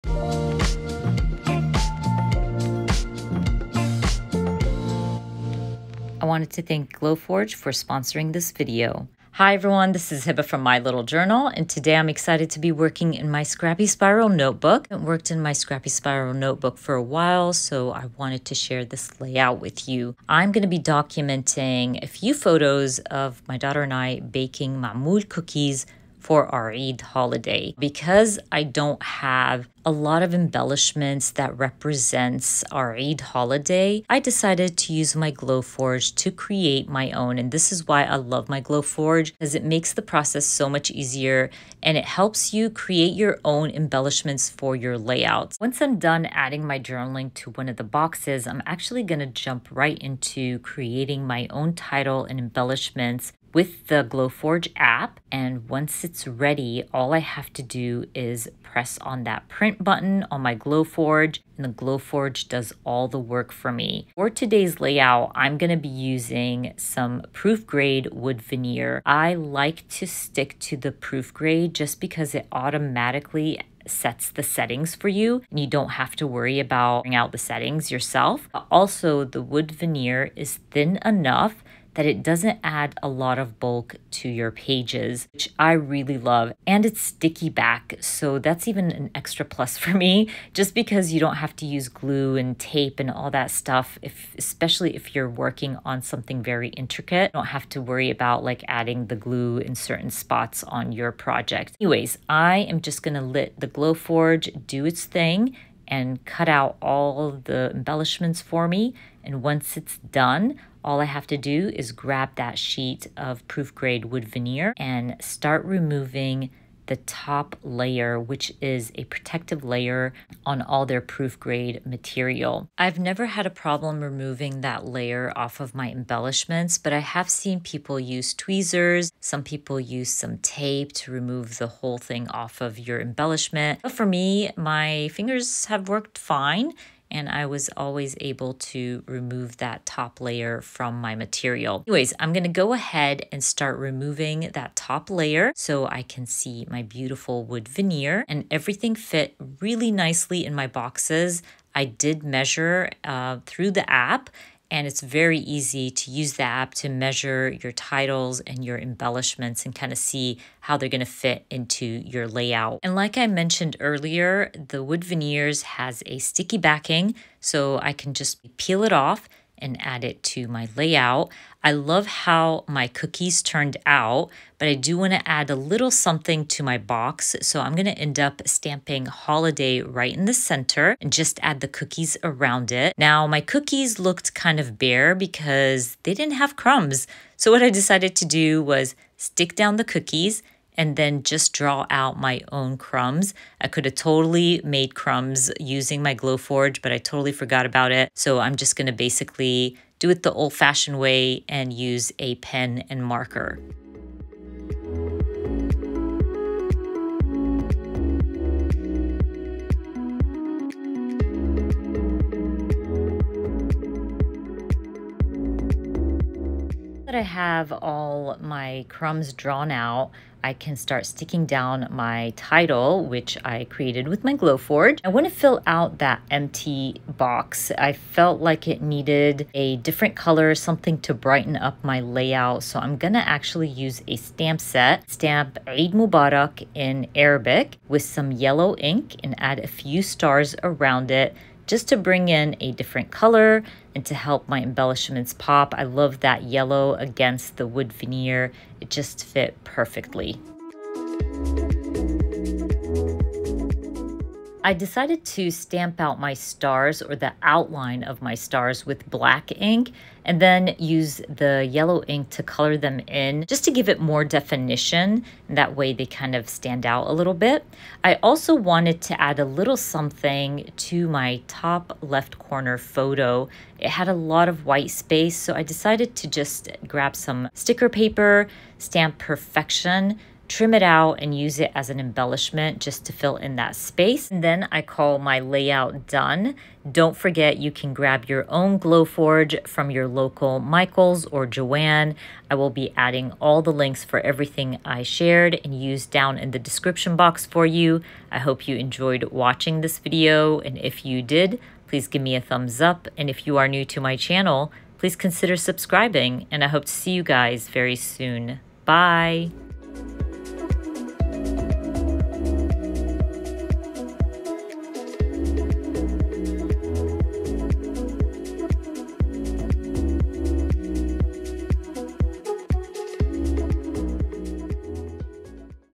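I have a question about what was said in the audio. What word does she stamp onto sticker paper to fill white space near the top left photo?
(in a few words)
perfection.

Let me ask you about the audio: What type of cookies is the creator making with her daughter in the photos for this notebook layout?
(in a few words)
mamul.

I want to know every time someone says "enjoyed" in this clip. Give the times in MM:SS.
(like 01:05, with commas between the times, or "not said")
04:58.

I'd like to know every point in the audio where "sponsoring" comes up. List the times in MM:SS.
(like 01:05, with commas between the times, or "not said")
00:07.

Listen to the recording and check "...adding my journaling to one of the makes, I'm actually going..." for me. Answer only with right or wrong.
wrong.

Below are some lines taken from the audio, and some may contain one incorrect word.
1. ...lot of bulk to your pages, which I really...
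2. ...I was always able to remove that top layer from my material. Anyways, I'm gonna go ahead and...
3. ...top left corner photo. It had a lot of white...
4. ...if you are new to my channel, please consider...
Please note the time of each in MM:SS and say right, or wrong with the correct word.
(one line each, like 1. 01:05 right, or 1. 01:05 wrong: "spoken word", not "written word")
1. 01:23 right
2. 02:17 right
3. 04:31 right
4. 05:03 right.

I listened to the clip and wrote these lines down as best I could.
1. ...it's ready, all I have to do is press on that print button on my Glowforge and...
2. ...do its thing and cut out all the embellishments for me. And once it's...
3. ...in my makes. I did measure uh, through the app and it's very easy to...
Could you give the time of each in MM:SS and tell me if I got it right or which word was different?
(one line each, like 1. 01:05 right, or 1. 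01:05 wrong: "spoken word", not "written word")
1. 00:56 right
2. 01:44 right
3. 02:30 wrong: "boxes", not "makes".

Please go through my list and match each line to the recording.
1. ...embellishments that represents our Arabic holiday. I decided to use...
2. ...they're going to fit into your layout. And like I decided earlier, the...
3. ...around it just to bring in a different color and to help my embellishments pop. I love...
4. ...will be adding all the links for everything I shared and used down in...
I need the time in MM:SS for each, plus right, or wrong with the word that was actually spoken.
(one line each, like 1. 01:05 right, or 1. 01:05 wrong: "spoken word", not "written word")
1. 00:30 wrong: "Eid", not "Arabic"
2. 02:40 wrong: "mentioned", not "decided"
3. 04:00 right
4. 04:52 right.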